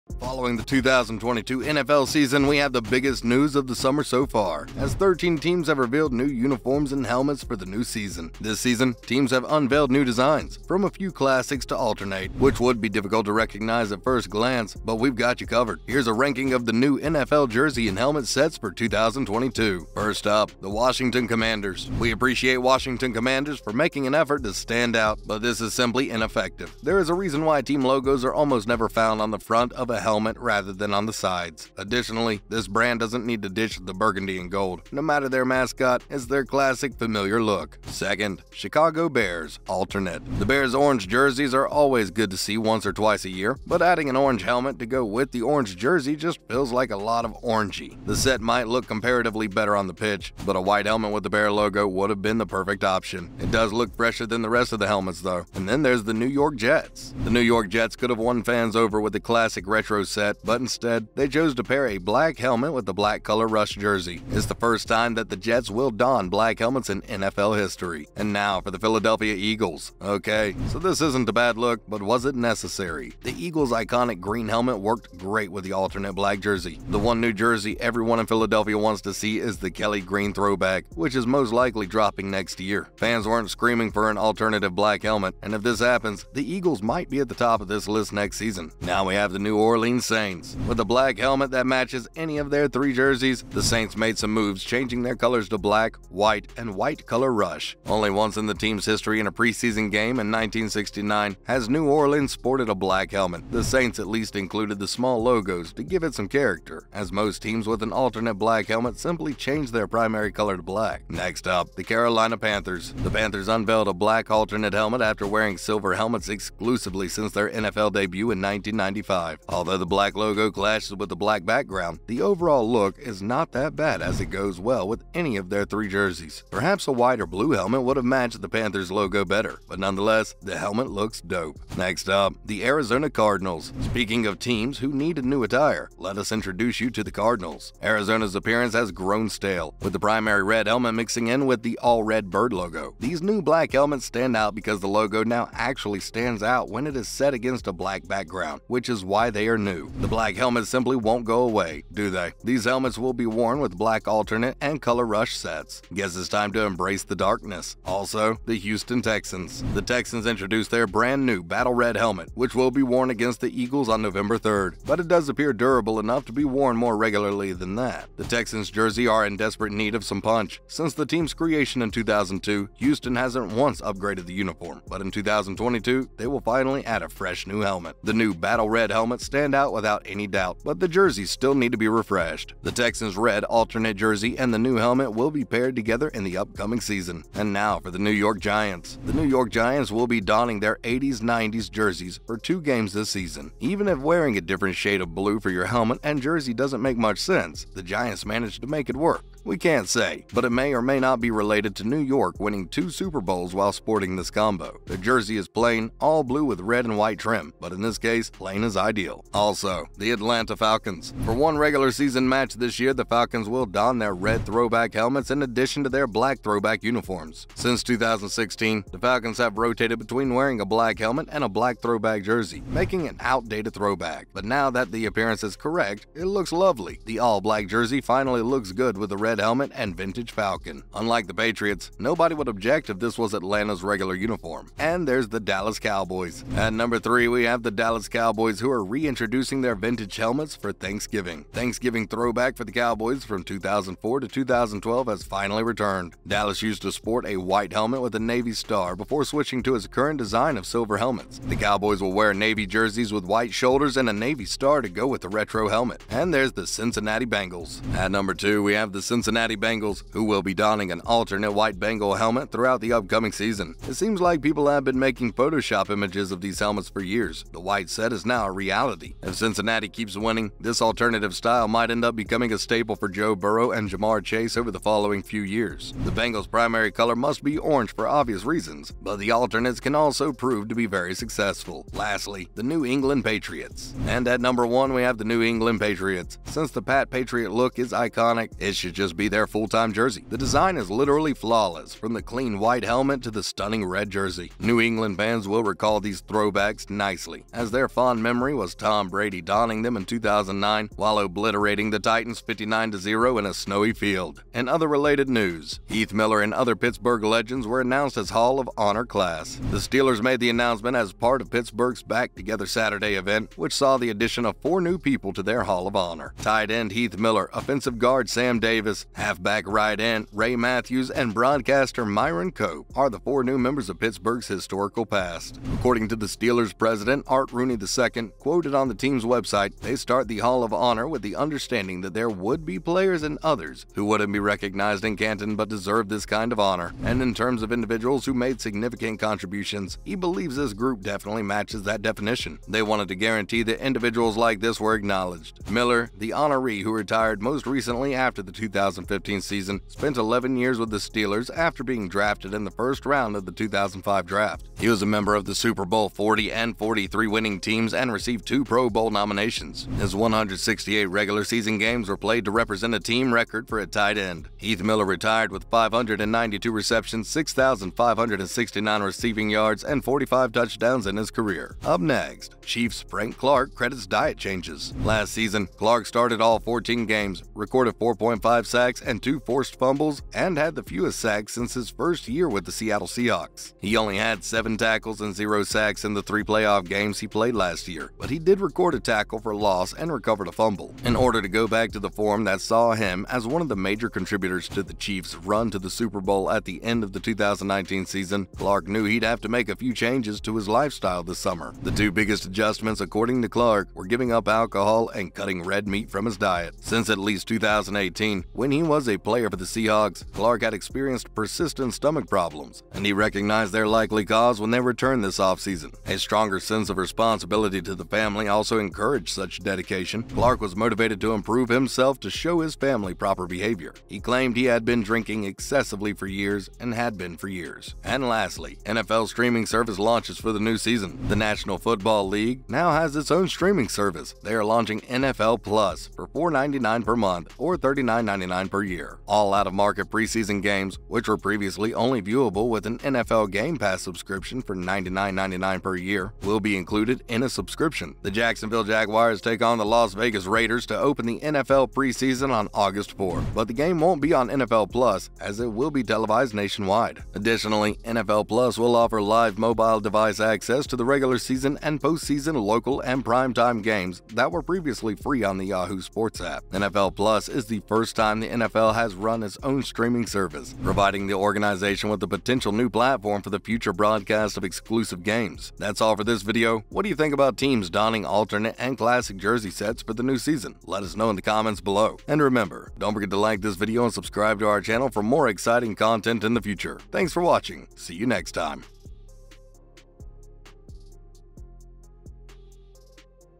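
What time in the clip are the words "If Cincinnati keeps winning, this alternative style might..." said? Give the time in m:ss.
4:29.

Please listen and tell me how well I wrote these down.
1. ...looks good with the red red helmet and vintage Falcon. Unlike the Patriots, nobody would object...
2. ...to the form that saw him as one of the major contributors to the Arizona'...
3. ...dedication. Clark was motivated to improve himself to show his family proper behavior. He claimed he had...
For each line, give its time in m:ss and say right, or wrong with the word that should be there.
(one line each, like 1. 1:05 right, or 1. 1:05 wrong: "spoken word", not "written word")
1. 3:48 right
2. 6:31 wrong: "Chiefs", not "Arizona"
3. 6:59 right.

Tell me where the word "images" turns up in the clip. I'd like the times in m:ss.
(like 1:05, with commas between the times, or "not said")
4:25.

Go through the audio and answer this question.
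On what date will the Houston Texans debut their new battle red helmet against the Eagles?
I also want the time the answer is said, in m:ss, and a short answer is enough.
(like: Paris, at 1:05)
November 3rd, at 2:44.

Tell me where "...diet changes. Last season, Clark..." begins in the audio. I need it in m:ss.
6:14.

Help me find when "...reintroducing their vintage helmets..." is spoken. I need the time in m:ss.
3:58.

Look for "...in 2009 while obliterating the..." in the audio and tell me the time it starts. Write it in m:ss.
4:59.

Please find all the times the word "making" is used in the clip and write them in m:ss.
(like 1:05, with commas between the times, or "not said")
0:23, 3:42, 4:24.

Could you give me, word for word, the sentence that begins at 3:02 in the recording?
The Texans' red alternate jersey and the new helmet will be paired together in the upcoming season.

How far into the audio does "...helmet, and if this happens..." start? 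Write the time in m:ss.
1:25.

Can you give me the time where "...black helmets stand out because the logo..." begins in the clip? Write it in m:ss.
2:23.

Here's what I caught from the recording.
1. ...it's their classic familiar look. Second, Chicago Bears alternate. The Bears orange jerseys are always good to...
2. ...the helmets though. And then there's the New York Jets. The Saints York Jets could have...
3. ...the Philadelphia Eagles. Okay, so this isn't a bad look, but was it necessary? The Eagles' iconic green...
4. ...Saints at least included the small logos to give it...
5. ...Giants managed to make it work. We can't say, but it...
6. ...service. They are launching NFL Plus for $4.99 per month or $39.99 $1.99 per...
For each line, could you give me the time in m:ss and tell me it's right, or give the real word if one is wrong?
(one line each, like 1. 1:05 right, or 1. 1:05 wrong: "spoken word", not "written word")
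1. 0:36 right
2. 0:54 wrong: "New", not "Saints"
3. 1:08 right
4. 1:43 right
5. 3:17 right
6. 7:13 right.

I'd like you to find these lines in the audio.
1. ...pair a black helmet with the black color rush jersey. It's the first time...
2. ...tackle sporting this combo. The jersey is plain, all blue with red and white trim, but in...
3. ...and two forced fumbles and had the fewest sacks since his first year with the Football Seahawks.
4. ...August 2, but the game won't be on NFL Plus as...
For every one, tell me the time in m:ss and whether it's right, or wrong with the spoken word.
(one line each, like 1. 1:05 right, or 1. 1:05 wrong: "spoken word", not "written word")
1. 1:01 right
2. 3:23 wrong: "while", not "tackle"
3. 6:19 wrong: "Seattle", not "Football"
4. 7:32 wrong: "4", not "2".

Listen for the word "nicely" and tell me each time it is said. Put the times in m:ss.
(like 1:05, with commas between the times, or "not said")
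4:56.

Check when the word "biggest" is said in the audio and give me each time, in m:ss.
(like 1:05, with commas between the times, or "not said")
0:02, 6:42.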